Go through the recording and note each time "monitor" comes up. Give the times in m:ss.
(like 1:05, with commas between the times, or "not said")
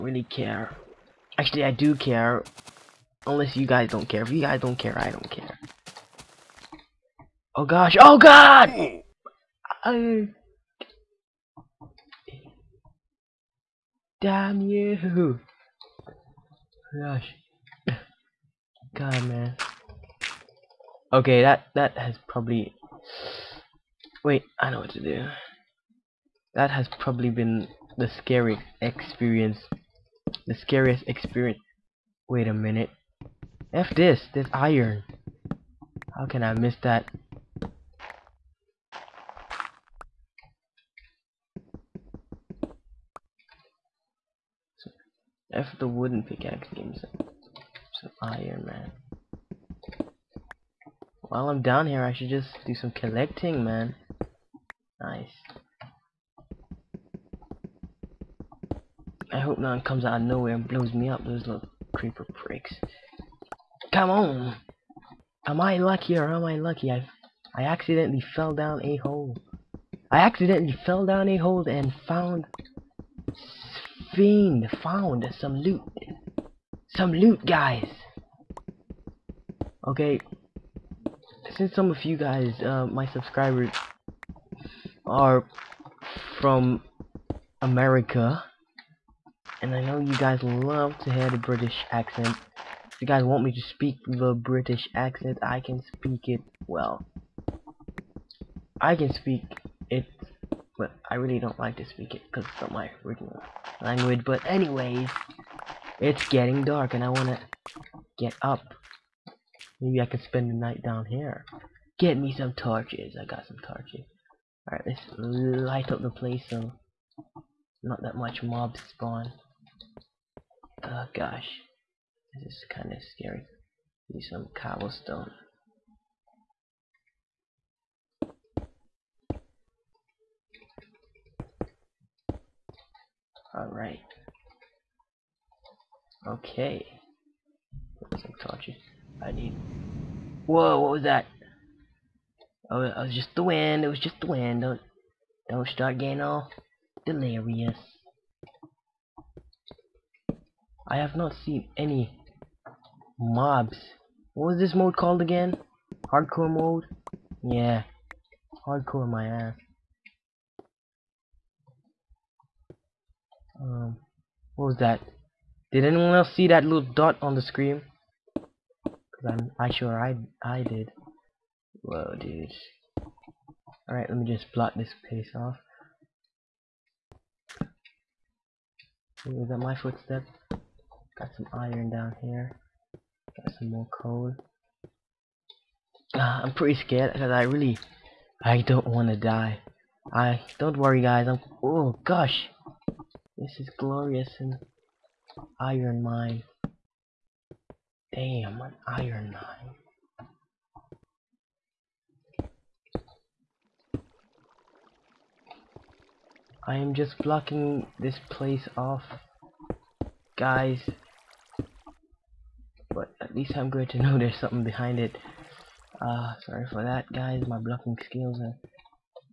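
not said.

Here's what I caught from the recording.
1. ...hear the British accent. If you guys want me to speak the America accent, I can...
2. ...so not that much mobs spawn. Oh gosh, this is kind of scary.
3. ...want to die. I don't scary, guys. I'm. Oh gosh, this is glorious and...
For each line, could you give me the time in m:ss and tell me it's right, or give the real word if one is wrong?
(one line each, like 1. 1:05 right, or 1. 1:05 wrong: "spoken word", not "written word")
1. 1:31 wrong: "British", not "America"
2. 1:56 right
3. 3:08 wrong: "worry", not "scary".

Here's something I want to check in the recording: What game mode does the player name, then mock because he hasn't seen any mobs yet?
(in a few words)
Hardcore mode.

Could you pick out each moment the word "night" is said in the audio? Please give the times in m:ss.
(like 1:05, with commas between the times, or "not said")
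1:50.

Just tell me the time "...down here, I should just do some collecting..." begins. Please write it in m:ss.
0:51.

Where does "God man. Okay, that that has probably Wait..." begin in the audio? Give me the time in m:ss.
0:18.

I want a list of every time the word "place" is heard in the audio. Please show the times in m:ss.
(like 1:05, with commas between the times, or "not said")
1:56, 2:55, 3:28.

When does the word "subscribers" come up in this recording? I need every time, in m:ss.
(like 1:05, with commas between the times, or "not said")
1:23.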